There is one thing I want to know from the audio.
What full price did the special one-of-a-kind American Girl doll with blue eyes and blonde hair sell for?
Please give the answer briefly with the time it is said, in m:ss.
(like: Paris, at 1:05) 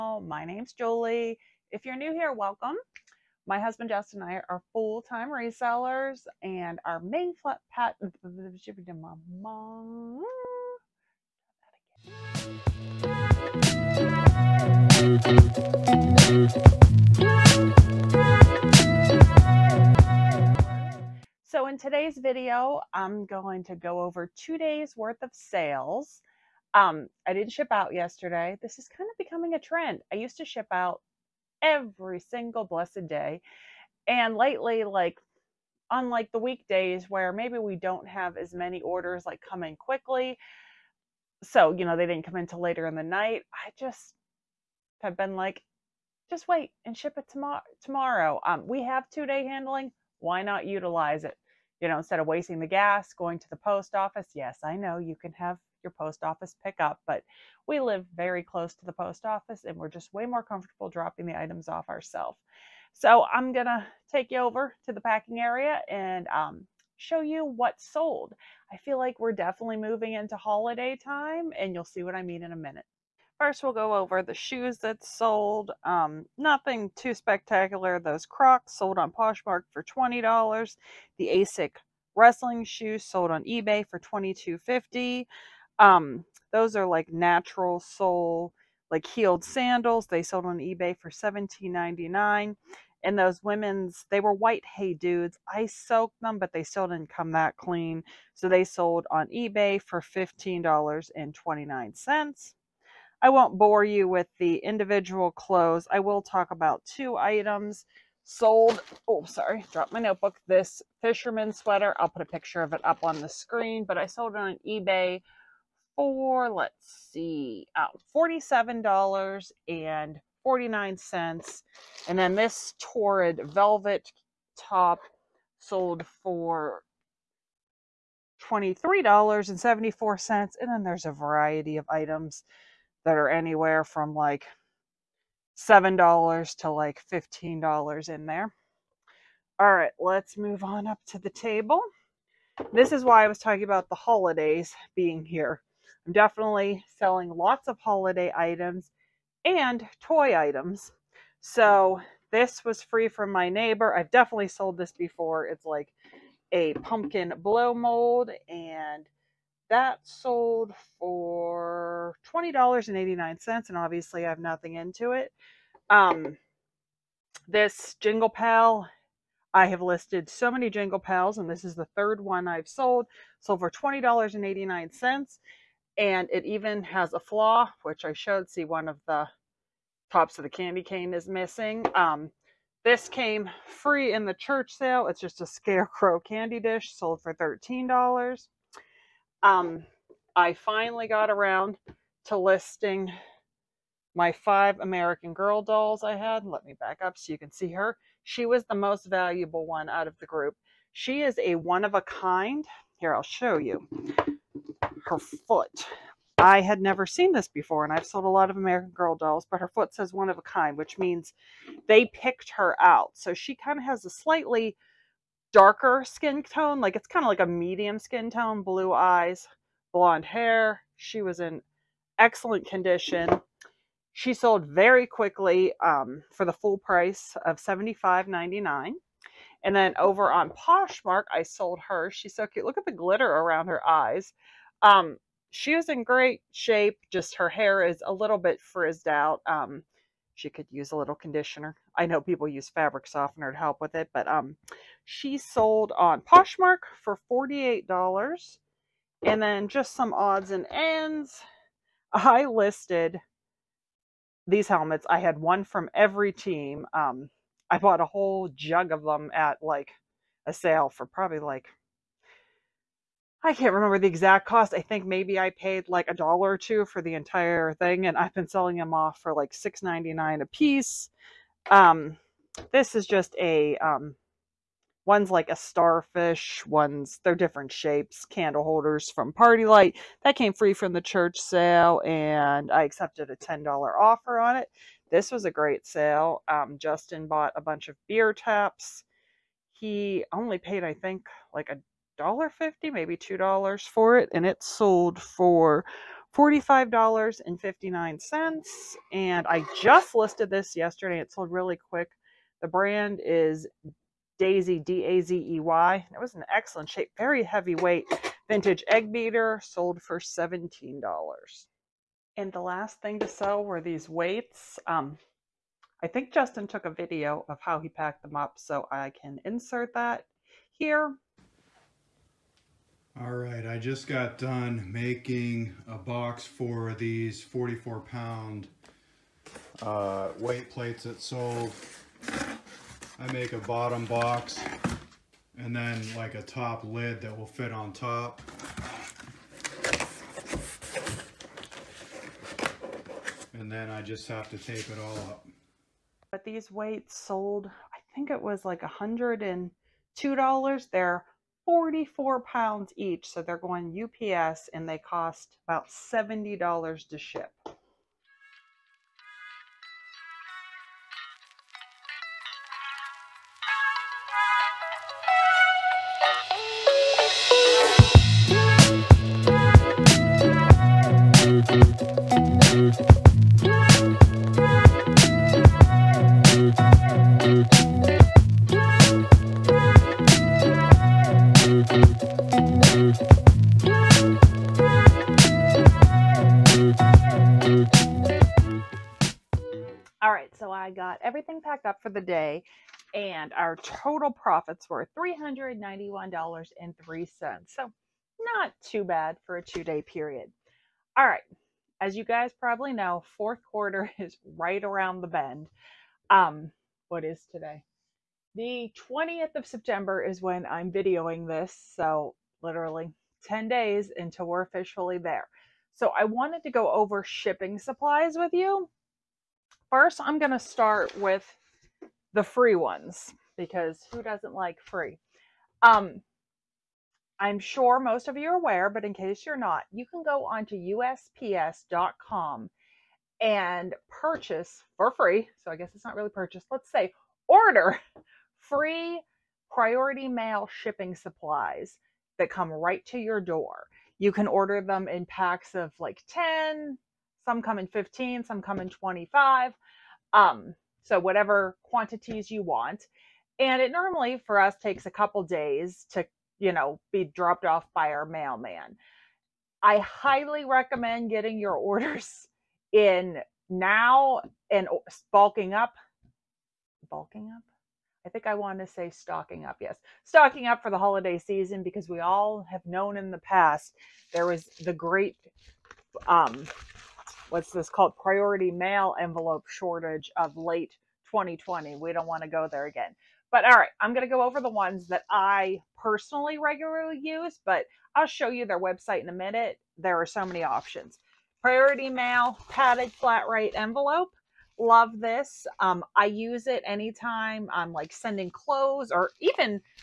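$75.99, at 3:47.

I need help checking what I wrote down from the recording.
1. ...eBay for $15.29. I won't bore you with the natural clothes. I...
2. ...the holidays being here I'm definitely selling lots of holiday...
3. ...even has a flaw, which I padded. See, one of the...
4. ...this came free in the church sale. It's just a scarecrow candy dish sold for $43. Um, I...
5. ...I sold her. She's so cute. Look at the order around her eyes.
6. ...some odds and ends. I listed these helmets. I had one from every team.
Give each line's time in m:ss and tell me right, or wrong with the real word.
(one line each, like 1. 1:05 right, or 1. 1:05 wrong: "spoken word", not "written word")
1. 1:39 wrong: "individual", not "natural"
2. 2:23 right
3. 2:56 wrong: "showed", not "padded"
4. 3:02 wrong: "13", not "43"
5. 3:51 wrong: "glitter", not "order"
6. 4:09 right.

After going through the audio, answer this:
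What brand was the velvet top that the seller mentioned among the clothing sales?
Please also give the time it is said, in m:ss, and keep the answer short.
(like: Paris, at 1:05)
Torrid, at 2:02.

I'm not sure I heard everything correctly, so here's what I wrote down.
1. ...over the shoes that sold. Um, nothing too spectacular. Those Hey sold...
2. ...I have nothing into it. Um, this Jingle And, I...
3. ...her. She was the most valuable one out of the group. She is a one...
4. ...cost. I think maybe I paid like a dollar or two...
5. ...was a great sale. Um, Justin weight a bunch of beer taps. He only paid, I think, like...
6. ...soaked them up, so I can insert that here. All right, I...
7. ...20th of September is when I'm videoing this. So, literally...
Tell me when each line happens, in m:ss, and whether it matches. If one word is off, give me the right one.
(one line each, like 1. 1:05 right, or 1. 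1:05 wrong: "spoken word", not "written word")
1. 1:13 wrong: "Crocs", not "Hey"
2. 2:44 wrong: "Pal", not "And"
3. 3:17 right
4. 4:24 right
5. 4:45 wrong: "bought", not "weight"
6. 5:17 wrong: "packed", not "soaked"
7. 6:49 right.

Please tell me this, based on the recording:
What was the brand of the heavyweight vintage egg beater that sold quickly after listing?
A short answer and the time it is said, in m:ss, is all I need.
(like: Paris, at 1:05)
Dazey, at 5:04.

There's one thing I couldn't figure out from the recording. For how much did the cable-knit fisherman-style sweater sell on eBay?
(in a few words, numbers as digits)
$47.49.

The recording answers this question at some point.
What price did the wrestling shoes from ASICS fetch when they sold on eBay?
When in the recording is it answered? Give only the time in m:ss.
1:23.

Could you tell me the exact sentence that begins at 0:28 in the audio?
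This is kind of becoming a trend.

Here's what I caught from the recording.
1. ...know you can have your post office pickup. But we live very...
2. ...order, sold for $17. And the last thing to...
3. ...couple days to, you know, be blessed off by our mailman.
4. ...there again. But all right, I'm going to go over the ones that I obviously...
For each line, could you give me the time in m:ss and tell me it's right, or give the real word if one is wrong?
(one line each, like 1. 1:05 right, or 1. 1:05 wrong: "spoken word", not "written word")
1. 0:54 right
2. 5:09 wrong: "beater", not "order"
3. 7:35 wrong: "dropped", not "blessed"
4. 8:02 wrong: "personally", not "obviously".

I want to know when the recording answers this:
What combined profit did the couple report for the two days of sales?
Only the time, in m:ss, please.
6:35.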